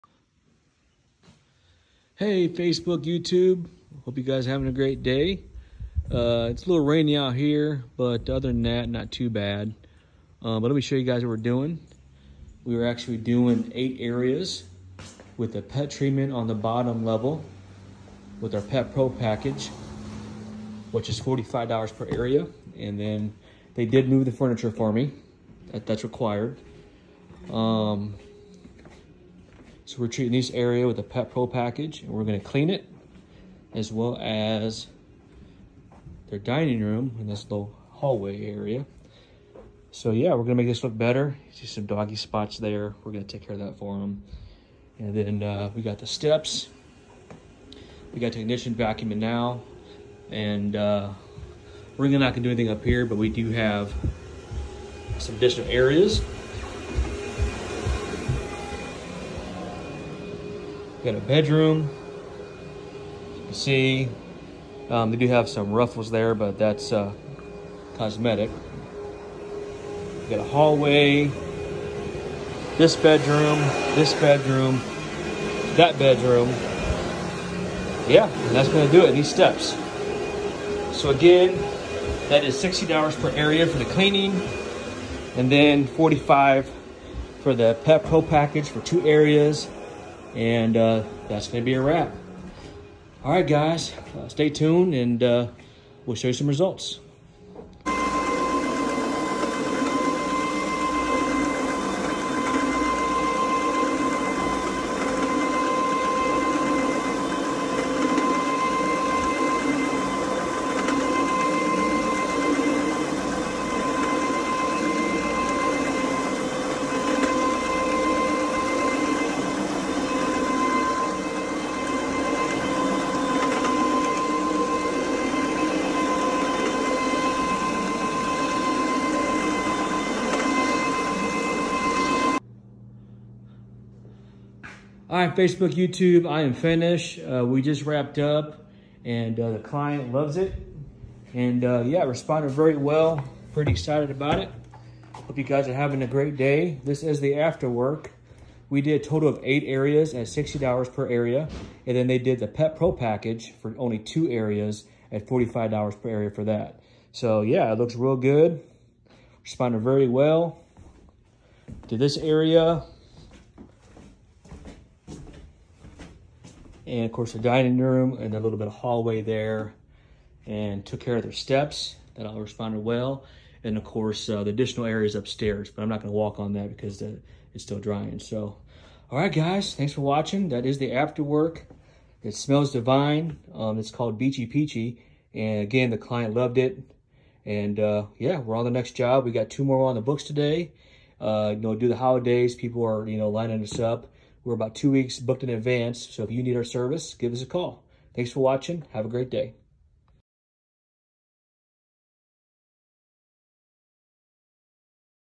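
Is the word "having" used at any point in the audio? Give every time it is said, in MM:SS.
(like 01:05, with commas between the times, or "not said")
00:04, 02:25.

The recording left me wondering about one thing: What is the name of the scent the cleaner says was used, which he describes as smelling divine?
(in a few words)
Beachy Peachy.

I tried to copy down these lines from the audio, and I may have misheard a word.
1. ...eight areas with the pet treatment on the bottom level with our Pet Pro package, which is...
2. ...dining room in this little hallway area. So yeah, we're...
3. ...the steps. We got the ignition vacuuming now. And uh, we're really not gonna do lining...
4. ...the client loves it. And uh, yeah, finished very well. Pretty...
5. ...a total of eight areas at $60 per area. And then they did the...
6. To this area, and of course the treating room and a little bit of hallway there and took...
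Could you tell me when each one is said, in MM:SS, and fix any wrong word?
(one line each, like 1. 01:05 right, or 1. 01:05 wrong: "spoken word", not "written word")
1. 00:13 right
2. 00:36 right
3. 00:45 wrong: "anything", not "lining"
4. 02:19 wrong: "responded", not "finished"
5. 02:29 right
6. 02:41 wrong: "dining", not "treating".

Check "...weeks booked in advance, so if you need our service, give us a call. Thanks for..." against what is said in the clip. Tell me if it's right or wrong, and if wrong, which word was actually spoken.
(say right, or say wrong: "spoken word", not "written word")
right.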